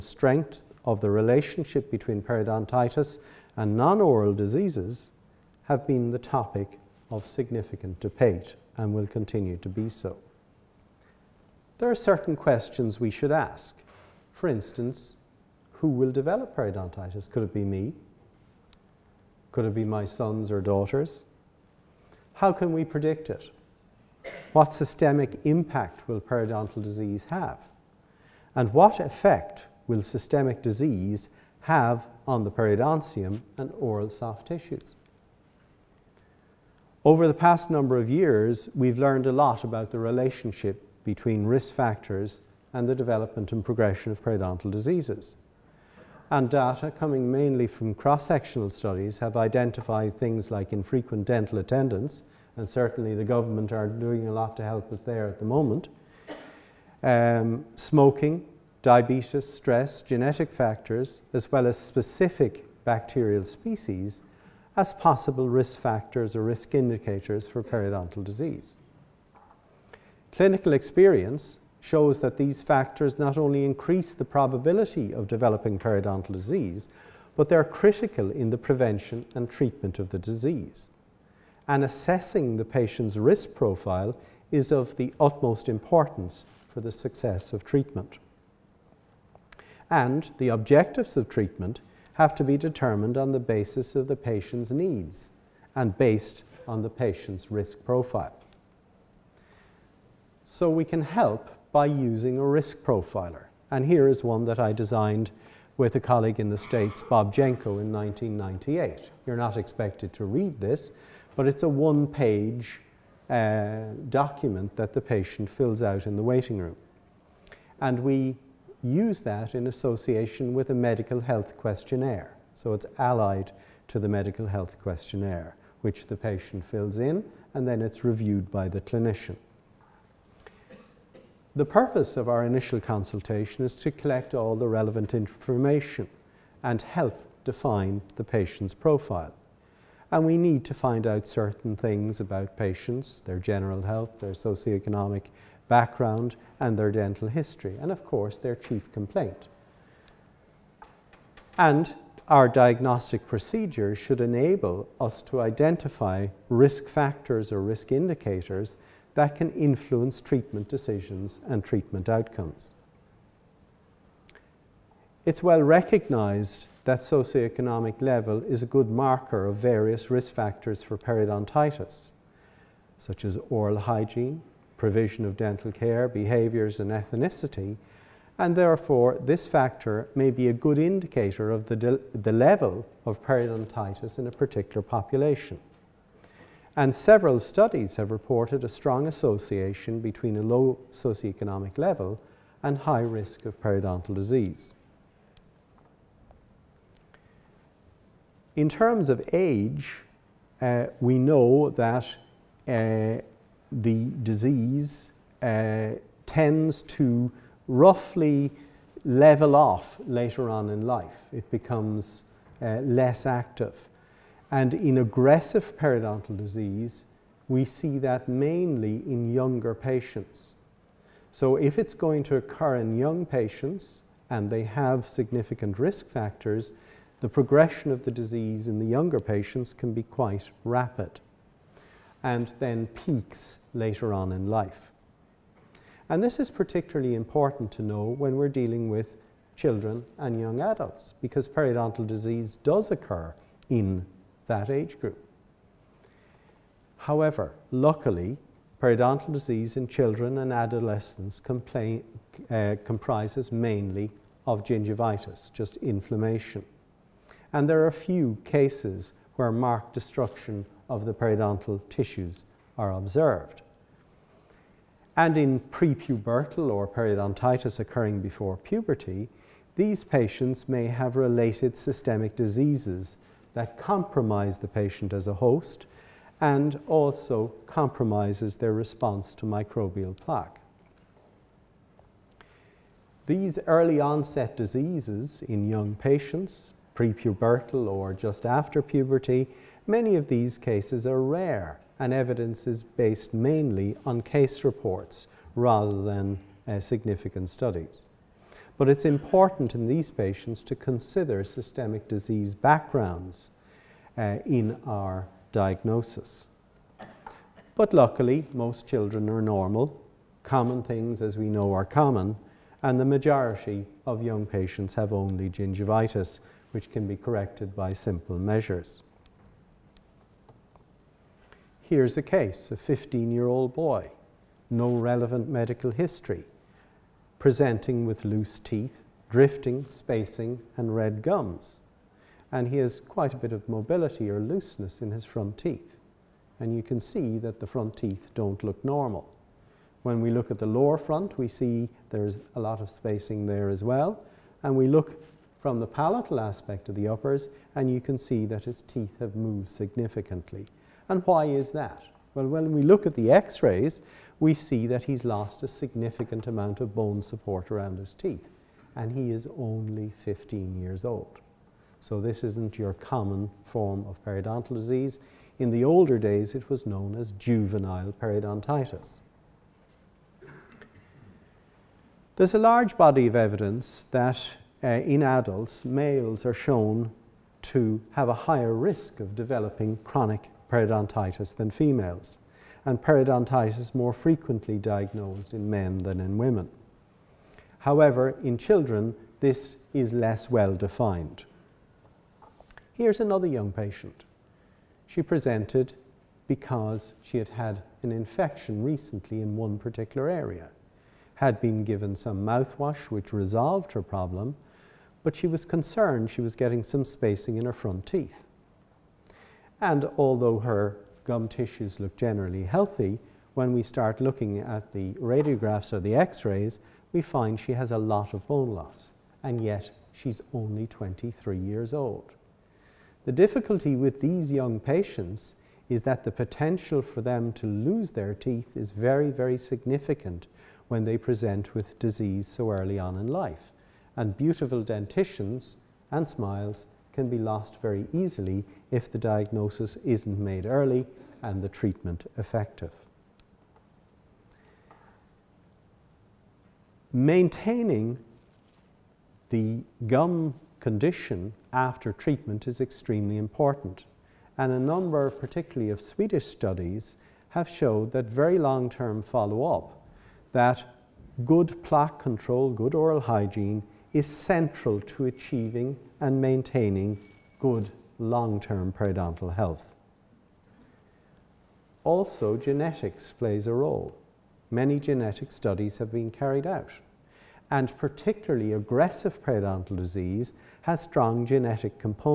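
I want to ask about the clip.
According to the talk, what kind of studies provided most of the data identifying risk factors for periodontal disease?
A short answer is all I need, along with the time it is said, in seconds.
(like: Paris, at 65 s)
cross-sectional studies, at 47 s.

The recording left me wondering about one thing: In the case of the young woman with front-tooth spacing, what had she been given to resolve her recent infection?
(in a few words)
mouthwash.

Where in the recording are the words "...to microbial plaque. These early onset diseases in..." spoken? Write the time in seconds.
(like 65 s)
279 s.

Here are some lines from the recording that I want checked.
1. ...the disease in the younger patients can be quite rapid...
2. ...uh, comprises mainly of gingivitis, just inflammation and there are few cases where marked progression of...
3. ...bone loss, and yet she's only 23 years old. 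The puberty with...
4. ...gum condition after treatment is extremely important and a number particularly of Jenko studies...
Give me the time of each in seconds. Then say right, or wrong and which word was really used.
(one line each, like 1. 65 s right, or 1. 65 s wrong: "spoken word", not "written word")
1. 228 s right
2. 252 s wrong: "destruction", not "progression"
3. 418 s wrong: "difficulty", not "puberty"
4. 450 s wrong: "Swedish", not "Jenko".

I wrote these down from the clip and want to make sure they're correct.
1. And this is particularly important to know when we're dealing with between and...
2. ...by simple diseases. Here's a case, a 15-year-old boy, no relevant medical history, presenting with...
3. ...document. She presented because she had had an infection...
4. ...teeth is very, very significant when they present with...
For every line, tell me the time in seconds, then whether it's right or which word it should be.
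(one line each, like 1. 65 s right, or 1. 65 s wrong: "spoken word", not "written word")
1. 236 s wrong: "children", not "between"
2. 317 s wrong: "measures", not "diseases"
3. 393 s wrong: "patient", not "document"
4. 428 s right.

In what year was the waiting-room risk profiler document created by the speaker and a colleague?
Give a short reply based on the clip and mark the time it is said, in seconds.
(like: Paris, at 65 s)
1998, at 107 s.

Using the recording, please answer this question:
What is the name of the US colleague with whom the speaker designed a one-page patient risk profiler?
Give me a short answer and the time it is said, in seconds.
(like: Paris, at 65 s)
Bob Jenko, at 107 s.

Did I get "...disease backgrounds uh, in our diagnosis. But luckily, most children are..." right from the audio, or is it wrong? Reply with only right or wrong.
right.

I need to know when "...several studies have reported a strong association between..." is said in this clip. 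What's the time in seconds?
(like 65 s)
186 s.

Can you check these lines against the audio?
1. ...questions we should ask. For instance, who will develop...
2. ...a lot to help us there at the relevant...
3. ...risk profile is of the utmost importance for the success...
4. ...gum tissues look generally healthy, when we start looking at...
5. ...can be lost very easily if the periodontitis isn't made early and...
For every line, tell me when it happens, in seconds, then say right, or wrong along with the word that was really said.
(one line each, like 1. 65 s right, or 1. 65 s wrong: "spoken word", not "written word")
1. 12 s right
2. 54 s wrong: "moment", not "relevant"
3. 83 s right
4. 411 s right
5. 437 s wrong: "diagnosis", not "periodontitis".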